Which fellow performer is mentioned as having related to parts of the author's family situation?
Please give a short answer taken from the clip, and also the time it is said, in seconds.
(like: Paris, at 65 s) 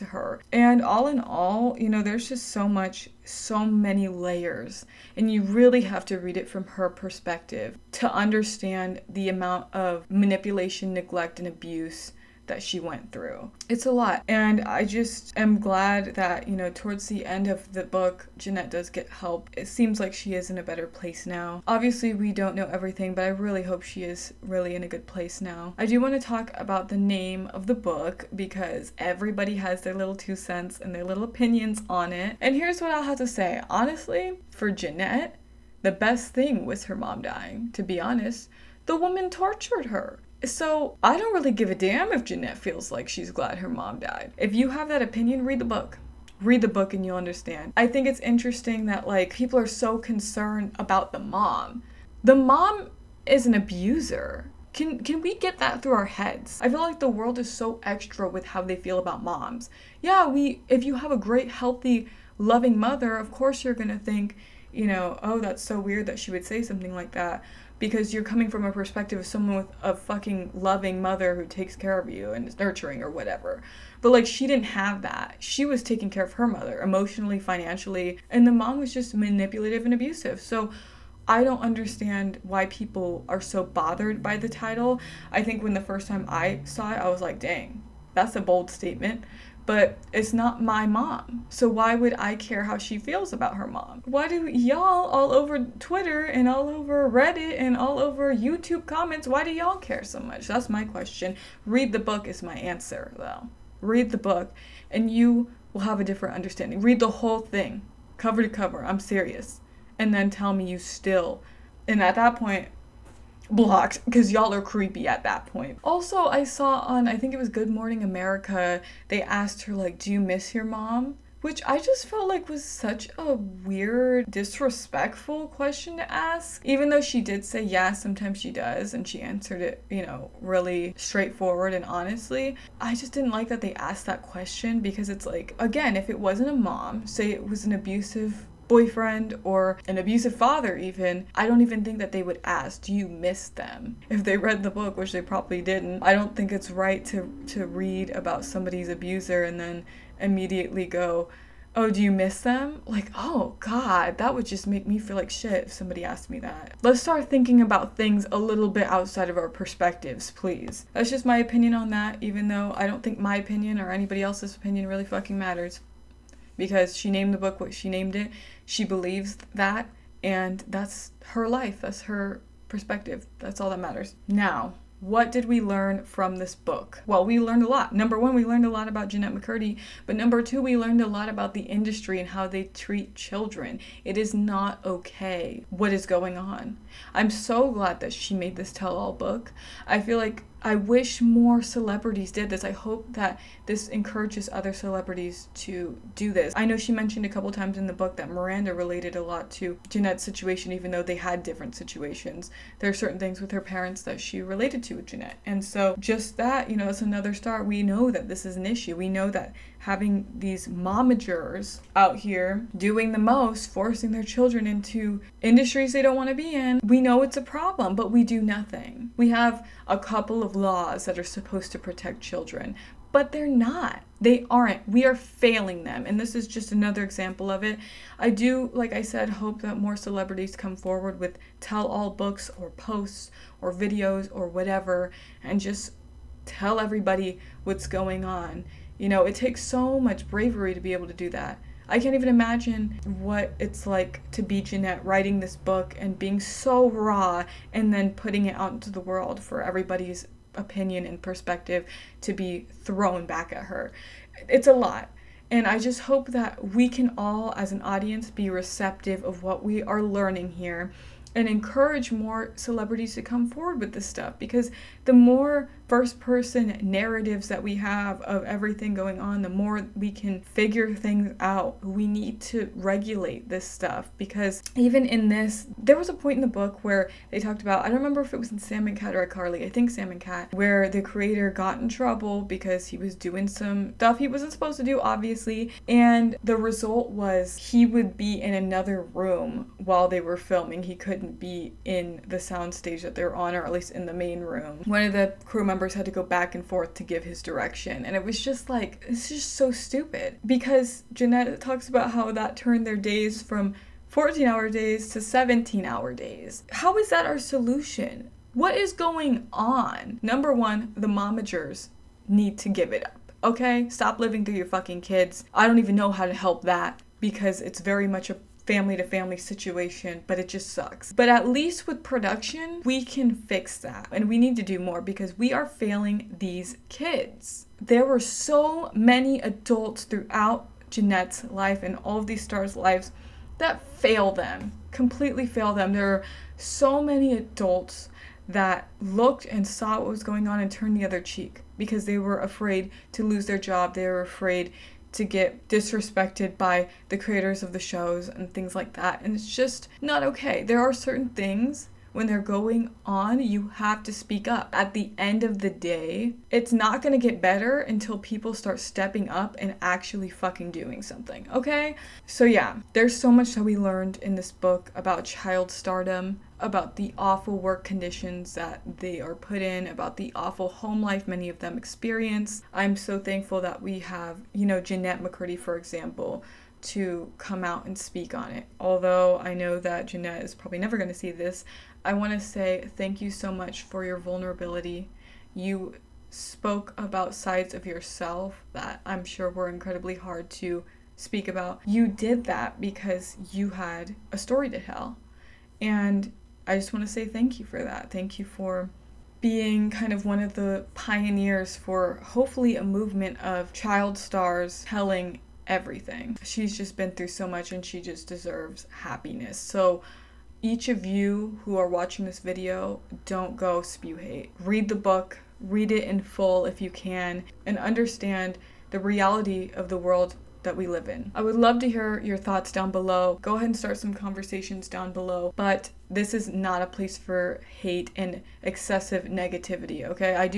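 Miranda, at 198 s.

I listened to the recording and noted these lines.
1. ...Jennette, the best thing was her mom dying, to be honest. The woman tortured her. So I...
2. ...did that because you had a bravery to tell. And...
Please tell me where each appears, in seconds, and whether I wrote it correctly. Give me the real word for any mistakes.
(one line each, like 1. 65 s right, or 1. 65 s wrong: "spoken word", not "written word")
1. 34 s right
2. 392 s wrong: "story", not "bravery".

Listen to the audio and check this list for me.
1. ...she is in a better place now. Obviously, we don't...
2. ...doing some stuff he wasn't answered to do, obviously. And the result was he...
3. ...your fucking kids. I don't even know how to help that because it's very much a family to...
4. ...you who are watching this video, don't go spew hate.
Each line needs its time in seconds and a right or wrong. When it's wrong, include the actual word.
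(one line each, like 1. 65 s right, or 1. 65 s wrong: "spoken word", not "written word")
1. 20 s right
2. 283 s wrong: "supposed", not "answered"
3. 314 s right
4. 411 s right.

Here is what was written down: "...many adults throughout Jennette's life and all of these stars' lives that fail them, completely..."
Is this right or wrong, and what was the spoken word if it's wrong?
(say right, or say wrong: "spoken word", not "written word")
right.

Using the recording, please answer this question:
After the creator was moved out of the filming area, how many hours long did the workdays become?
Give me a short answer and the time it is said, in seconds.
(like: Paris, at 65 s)
17, at 305 s.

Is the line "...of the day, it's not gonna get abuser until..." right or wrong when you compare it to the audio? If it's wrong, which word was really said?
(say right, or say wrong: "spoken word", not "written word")
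wrong: "better", not "abuser".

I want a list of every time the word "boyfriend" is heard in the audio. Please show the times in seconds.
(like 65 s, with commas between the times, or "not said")
138 s.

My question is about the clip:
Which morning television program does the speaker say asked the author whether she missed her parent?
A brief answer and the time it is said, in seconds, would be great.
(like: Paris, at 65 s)
Good Morning America, at 117 s.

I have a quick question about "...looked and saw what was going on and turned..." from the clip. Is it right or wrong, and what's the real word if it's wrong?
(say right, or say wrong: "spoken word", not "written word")
right.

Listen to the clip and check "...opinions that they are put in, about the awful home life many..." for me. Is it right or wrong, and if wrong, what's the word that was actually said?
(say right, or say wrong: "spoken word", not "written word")
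wrong: "conditions", not "opinions".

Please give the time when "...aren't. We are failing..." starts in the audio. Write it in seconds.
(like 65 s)
224 s.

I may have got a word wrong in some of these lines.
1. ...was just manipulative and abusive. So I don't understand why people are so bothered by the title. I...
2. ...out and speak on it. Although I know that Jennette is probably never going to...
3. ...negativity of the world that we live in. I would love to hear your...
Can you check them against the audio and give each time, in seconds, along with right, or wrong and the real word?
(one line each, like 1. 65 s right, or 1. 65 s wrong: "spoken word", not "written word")
1. 78 s right
2. 377 s right
3. 418 s wrong: "reality", not "negativity".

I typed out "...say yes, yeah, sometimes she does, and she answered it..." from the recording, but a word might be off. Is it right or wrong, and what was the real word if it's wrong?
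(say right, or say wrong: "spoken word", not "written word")
right.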